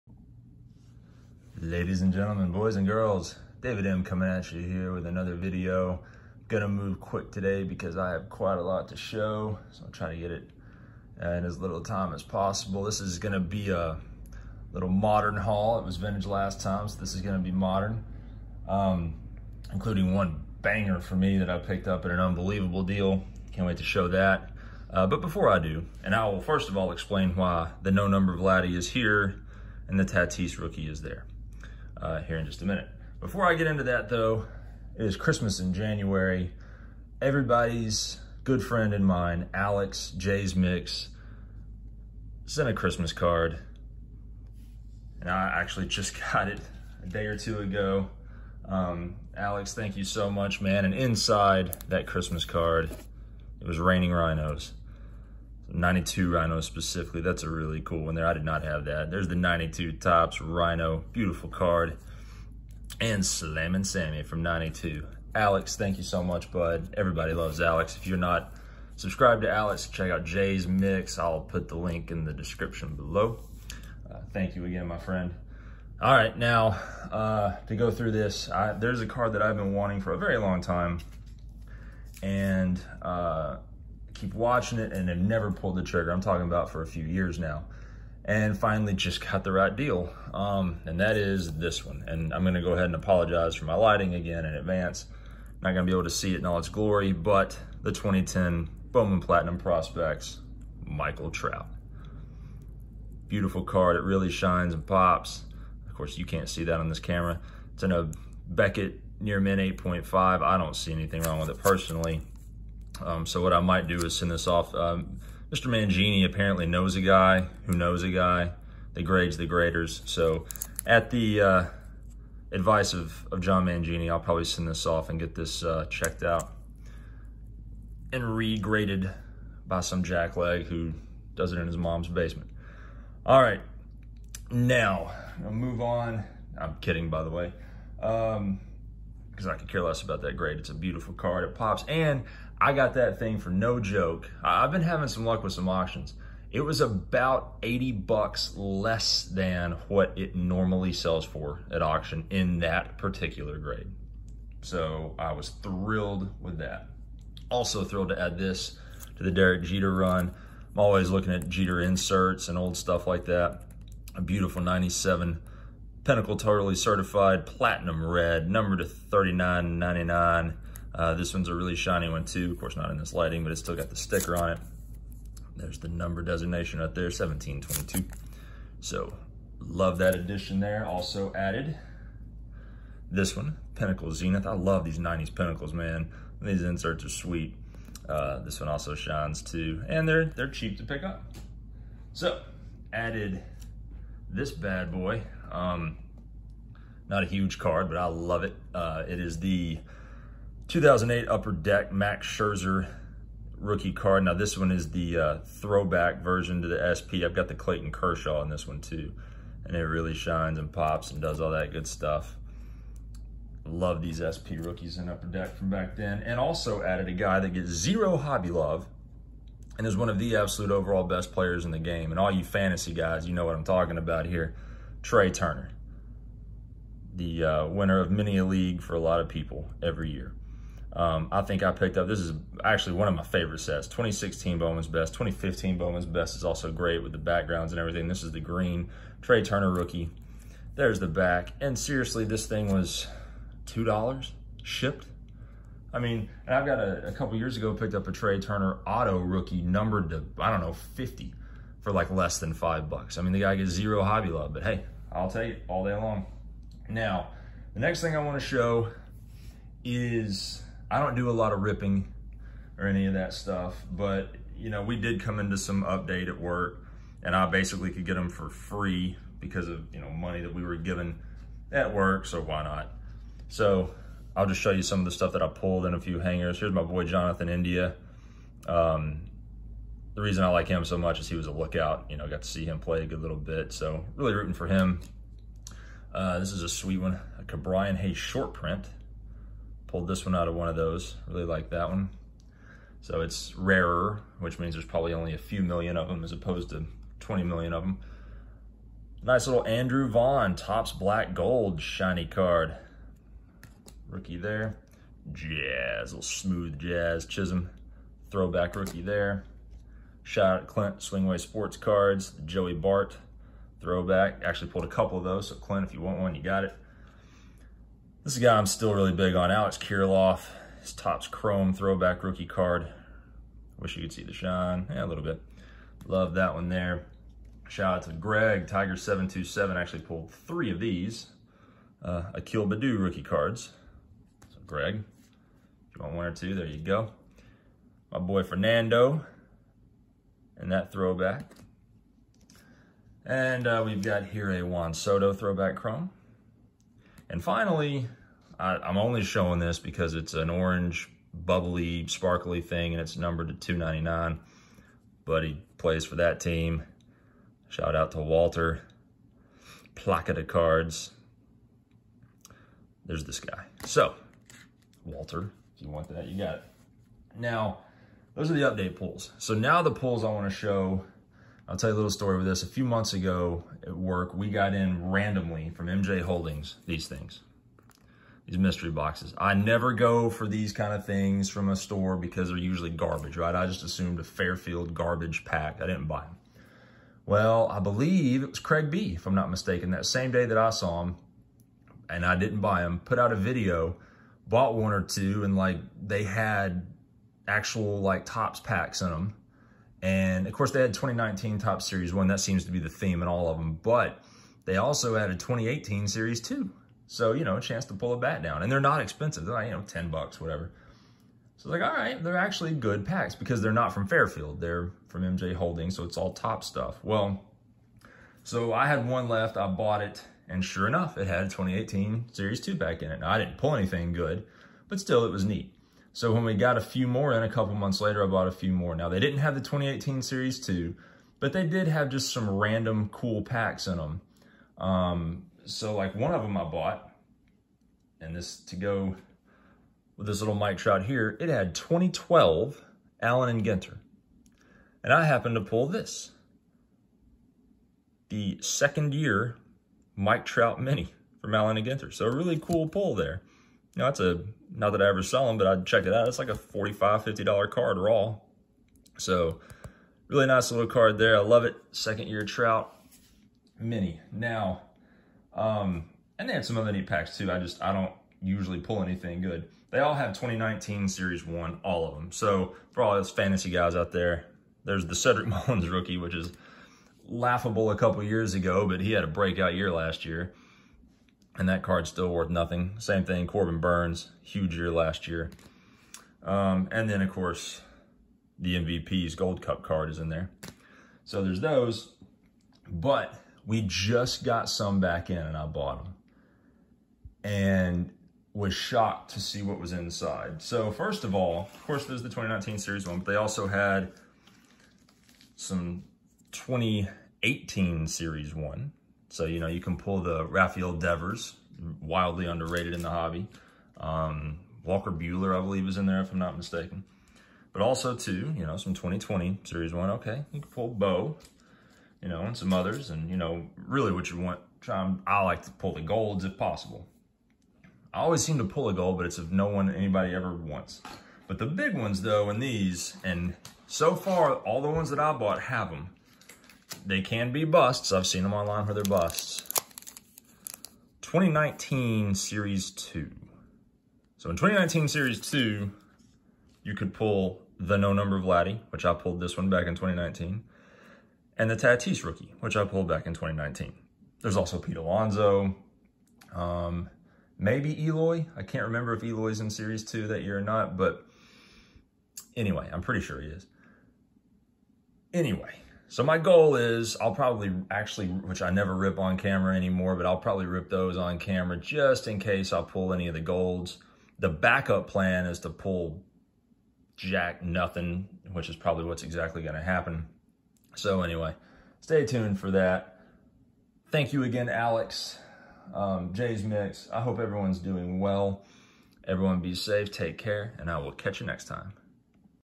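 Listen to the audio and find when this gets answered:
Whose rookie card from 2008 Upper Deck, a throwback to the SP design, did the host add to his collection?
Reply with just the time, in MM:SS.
03:21.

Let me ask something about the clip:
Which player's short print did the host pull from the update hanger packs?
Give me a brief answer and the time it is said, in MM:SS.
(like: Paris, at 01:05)
Ke'Bryan Hayes, at 04:47.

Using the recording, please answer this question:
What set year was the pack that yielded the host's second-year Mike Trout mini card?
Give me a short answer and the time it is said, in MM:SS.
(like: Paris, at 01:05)
2012, at 07:21.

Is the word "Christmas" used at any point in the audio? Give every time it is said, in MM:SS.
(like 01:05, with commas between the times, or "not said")
00:35, 00:42, 00:52.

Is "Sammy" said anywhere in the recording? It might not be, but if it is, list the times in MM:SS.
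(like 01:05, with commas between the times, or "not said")
01:03.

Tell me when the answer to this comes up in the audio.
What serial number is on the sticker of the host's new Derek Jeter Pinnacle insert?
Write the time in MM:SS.
02:57.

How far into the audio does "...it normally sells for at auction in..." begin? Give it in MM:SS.
02:30.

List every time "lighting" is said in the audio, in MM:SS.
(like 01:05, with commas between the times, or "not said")
01:33, 02:53.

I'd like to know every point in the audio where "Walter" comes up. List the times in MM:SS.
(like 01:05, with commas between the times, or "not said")
05:58, 06:05.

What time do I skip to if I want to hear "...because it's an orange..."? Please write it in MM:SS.
05:49.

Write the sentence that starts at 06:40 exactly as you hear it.
And of course they had 2019 Topps series one.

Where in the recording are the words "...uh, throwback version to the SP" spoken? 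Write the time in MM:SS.
03:25.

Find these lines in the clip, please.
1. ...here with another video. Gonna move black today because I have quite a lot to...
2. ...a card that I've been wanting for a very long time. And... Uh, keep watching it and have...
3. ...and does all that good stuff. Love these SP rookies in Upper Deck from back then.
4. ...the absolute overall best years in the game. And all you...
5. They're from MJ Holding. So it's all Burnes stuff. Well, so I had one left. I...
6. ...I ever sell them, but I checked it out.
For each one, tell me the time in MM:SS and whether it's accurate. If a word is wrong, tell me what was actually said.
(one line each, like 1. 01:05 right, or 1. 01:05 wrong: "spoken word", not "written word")
1. 00:04 wrong: "quick", not "black"
2. 01:19 right
3. 03:31 right
4. 03:40 wrong: "players", not "years"
5. 06:54 wrong: "Topps", not "Burnes"
6. 07:35 right.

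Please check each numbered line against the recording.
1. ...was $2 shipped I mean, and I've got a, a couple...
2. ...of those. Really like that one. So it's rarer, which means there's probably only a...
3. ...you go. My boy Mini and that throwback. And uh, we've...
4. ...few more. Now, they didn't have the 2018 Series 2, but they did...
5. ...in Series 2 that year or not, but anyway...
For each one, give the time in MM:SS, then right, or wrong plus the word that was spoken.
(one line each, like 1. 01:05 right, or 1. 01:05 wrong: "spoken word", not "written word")
1. 04:02 right
2. 04:50 right
3. 05:36 wrong: "Fernando", not "Mini"
4. 07:08 right
5. 09:19 right.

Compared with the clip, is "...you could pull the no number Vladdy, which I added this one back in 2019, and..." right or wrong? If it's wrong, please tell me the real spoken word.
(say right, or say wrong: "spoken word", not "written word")
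wrong: "pulled", not "added".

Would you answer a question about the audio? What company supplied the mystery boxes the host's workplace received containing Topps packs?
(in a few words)
MJ Holdings.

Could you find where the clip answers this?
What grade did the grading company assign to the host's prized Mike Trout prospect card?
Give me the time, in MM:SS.
01:49.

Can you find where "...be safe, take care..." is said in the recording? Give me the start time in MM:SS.
09:49.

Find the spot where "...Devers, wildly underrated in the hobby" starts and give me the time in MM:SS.
08:30.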